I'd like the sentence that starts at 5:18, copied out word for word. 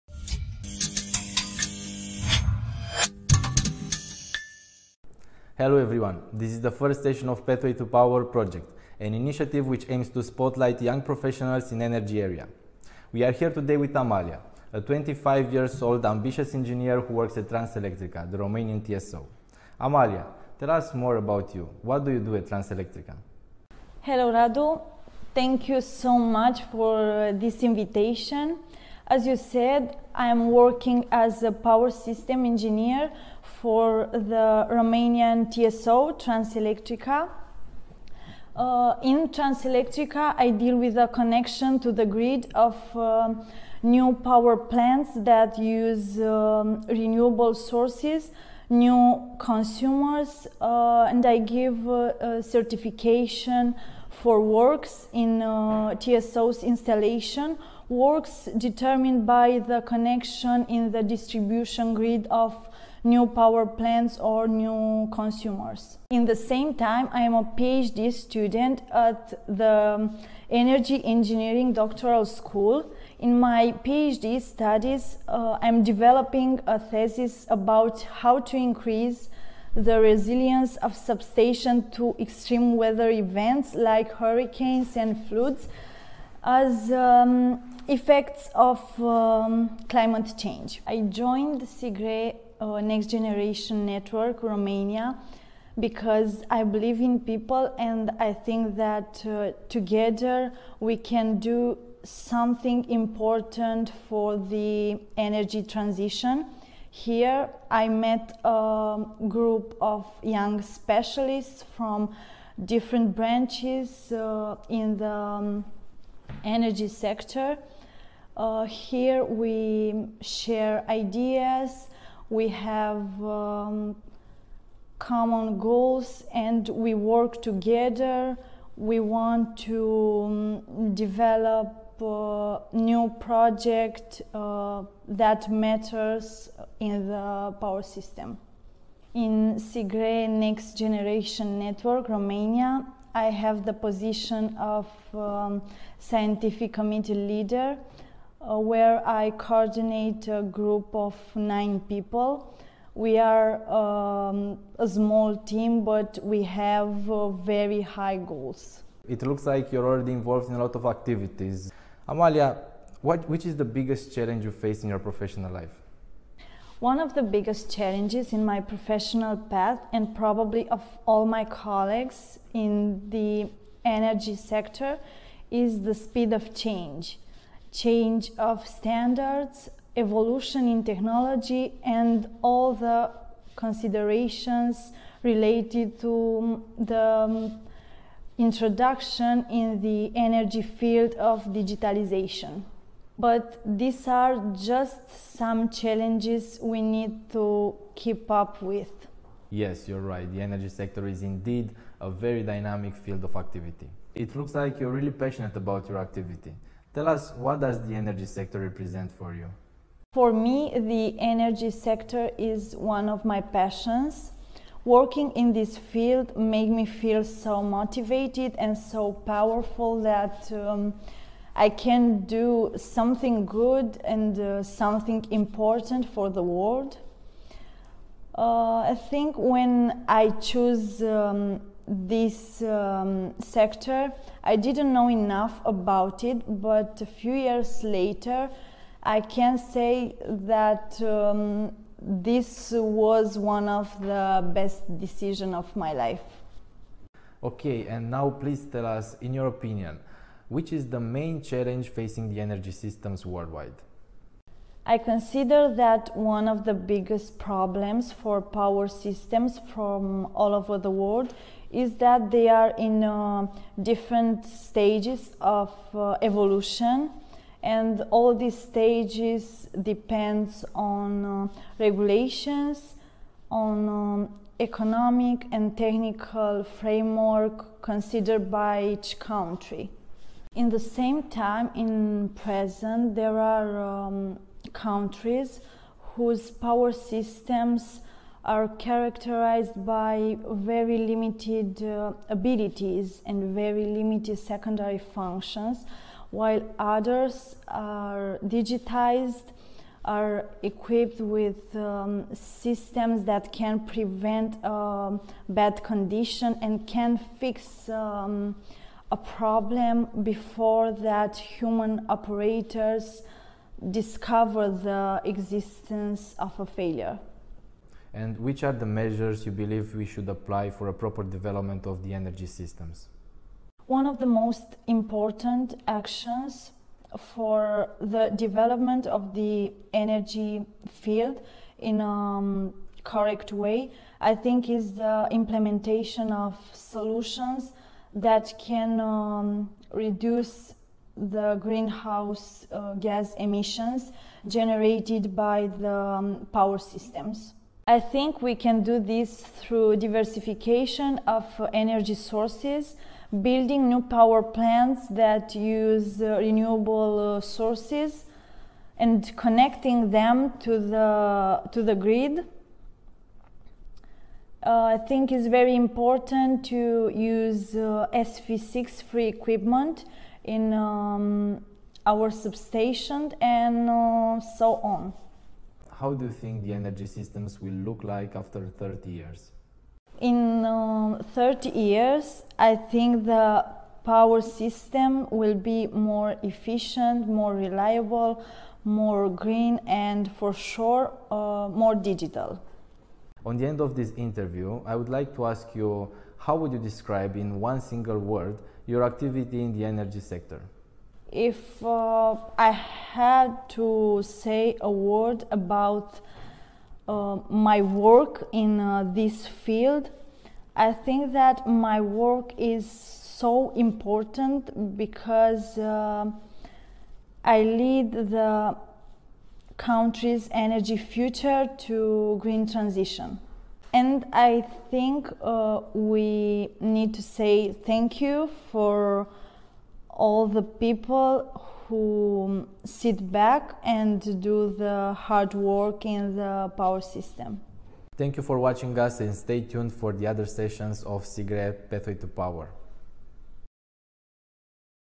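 And which are the measures you believe we should apply for a proper development of the energy systems?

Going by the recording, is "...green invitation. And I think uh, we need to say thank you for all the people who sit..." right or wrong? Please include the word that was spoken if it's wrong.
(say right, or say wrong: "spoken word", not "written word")
wrong: "transition", not "invitation".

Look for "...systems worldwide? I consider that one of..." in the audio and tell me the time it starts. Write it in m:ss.
4:12.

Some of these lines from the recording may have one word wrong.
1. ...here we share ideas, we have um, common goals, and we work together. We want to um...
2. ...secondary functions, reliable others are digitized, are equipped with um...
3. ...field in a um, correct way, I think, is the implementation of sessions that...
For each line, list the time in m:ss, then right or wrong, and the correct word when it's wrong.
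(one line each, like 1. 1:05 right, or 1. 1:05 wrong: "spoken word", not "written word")
1. 1:58 right
2. 4:54 wrong: "while", not "reliable"
3. 5:30 wrong: "solutions", not "sessions".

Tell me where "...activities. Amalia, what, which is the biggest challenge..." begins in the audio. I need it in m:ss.
2:40.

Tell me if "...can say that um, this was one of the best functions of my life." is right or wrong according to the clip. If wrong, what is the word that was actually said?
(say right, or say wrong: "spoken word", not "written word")
wrong: "decisions", not "functions".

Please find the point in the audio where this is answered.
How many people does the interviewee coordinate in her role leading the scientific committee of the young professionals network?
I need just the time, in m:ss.
2:31.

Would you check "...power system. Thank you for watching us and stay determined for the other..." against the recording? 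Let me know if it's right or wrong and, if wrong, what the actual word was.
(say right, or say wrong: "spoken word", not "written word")
wrong: "tuned", not "determined".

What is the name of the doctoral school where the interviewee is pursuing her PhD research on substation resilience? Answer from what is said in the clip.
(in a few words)
Energy Engineering Doctoral School.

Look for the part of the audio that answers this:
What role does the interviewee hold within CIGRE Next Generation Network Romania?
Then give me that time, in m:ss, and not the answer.
2:25.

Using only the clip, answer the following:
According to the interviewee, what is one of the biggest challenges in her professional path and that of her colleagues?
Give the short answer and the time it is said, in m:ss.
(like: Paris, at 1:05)
speed of change, at 2:55.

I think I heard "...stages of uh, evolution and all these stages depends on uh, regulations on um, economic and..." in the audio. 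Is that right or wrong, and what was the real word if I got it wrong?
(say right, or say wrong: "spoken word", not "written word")
right.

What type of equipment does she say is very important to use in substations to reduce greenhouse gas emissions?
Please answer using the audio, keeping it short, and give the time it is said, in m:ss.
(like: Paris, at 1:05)
SF6 free equipment, at 6:08.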